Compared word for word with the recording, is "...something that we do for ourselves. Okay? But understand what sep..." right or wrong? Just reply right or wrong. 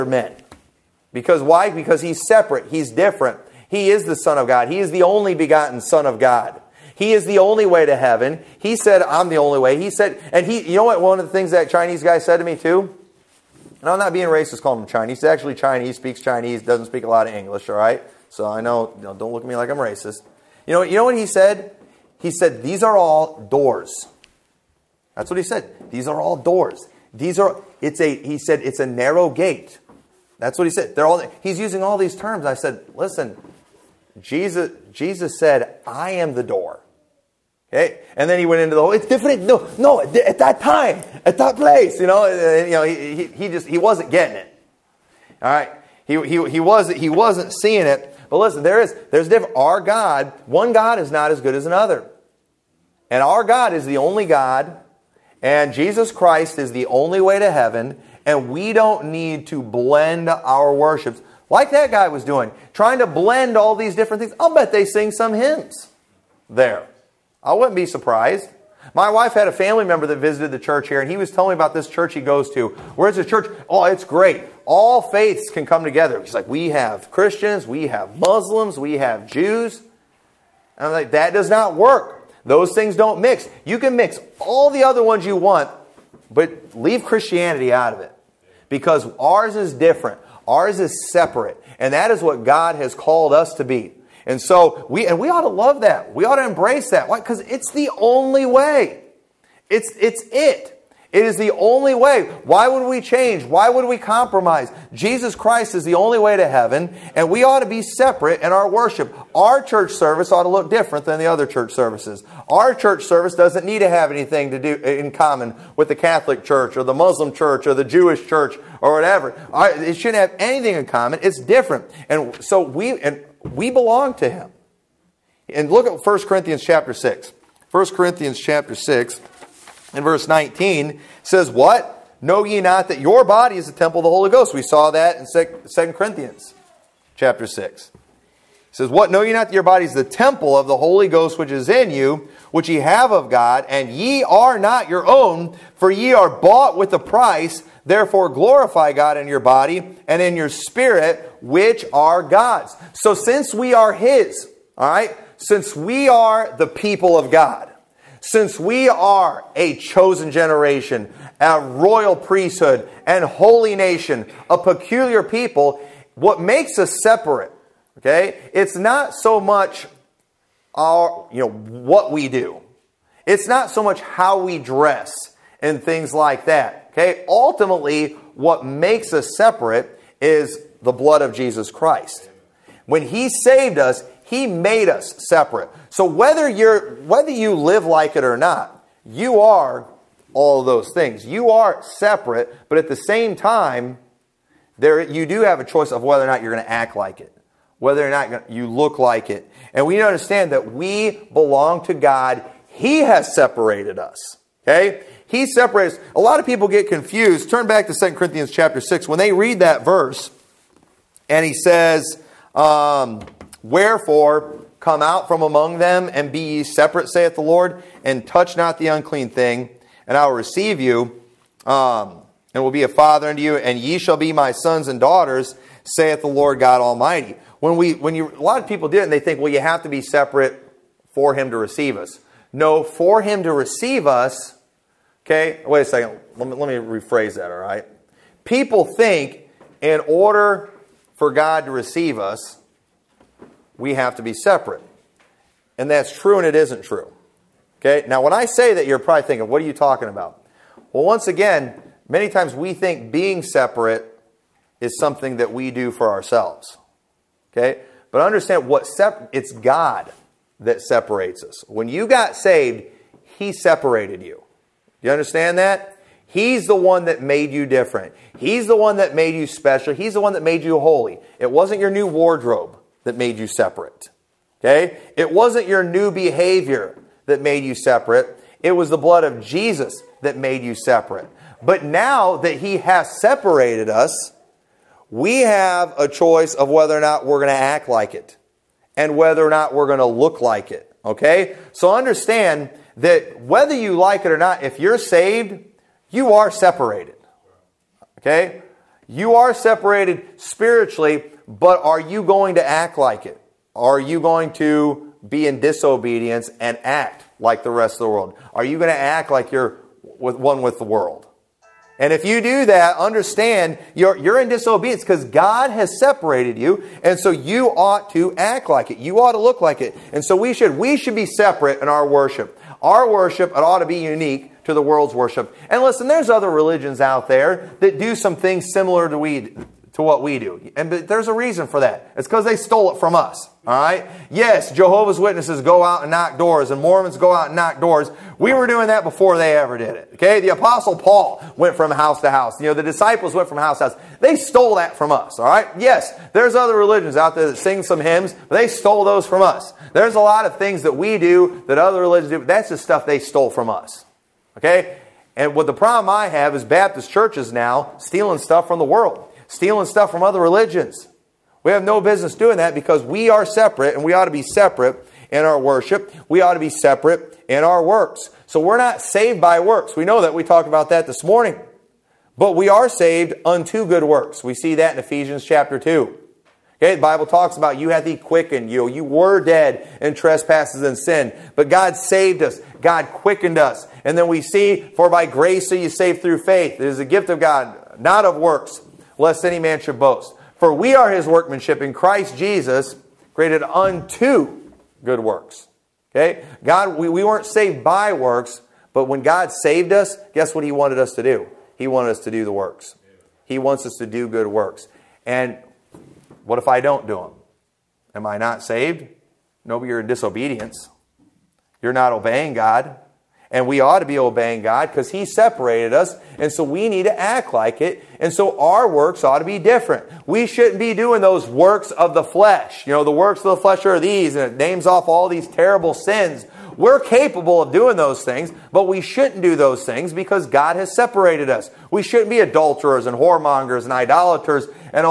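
right.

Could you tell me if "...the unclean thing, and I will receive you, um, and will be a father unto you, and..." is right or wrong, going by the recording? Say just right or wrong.
right.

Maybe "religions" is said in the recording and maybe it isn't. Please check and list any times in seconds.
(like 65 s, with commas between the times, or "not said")
326 s, 346 s, 352 s, 360 s.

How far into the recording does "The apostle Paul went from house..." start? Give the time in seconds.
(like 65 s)
340 s.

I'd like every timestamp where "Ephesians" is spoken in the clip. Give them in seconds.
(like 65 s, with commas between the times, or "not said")
374 s.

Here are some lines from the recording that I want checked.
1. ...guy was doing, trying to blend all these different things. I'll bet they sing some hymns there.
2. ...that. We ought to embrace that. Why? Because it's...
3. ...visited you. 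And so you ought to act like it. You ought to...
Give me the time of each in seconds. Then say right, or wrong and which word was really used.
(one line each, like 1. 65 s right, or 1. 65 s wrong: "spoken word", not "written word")
1. 61 s right
2. 95 s right
3. 315 s wrong: "separated", not "visited".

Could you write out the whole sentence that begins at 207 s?
Turn back to 2 Corinthians chapter 6.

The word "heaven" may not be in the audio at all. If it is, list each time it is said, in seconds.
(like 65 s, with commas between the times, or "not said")
7 s, 57 s, 106 s.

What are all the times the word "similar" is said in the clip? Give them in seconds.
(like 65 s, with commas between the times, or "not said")
328 s.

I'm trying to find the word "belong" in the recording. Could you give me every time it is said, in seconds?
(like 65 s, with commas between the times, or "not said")
123 s, 201 s.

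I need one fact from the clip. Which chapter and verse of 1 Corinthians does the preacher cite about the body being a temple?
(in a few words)
Chapter 6, verse 19.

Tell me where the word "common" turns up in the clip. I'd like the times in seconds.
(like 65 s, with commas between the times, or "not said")
115 s, 120 s.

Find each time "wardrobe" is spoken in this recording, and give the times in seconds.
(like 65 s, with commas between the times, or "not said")
272 s.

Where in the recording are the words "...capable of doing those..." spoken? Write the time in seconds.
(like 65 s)
426 s.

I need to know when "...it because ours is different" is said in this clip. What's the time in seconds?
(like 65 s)
87 s.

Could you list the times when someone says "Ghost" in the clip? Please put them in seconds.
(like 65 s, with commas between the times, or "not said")
134 s, 141 s.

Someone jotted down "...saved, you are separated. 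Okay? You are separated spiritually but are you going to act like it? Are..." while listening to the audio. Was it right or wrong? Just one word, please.
right.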